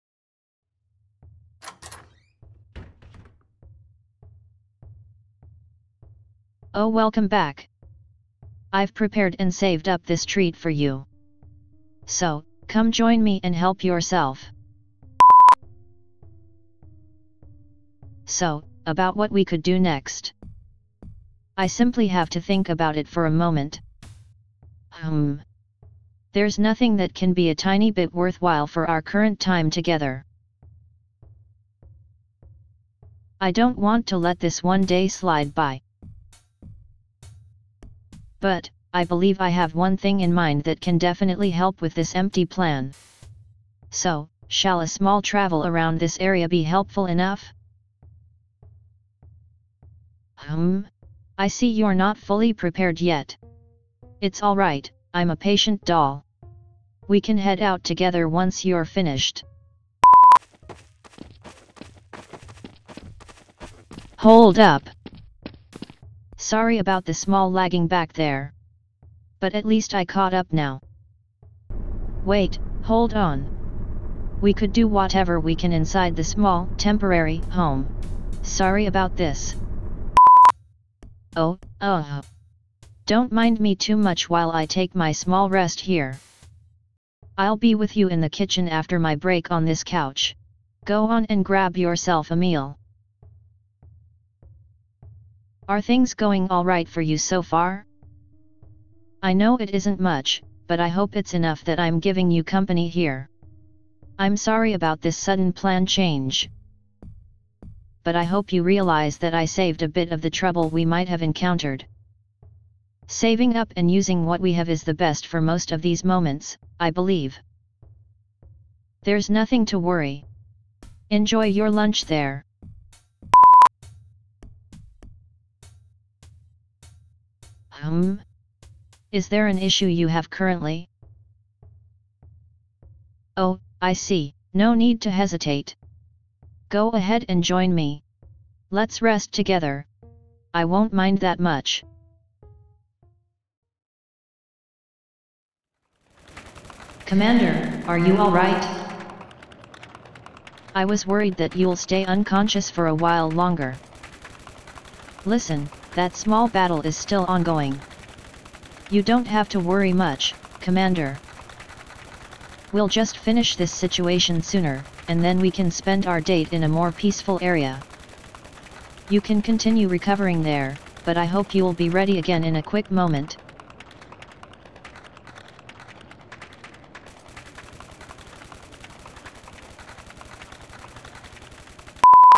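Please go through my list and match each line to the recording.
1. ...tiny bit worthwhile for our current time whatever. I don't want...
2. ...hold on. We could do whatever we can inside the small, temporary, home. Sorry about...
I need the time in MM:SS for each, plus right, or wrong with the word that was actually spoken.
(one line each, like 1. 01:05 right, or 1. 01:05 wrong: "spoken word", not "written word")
1. 00:27 wrong: "together", not "whatever"
2. 01:12 right.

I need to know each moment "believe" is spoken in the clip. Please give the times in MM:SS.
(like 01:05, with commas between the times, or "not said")
00:39, 01:56.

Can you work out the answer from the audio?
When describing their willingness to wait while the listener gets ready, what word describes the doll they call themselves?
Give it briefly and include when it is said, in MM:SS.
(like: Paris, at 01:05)
patient, at 00:55.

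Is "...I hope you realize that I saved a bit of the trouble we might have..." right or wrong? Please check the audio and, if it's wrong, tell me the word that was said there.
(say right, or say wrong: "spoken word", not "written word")
right.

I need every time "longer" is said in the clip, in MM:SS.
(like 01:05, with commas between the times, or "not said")
02:33.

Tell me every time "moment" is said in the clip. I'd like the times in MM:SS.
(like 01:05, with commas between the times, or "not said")
00:23, 01:56, 02:52.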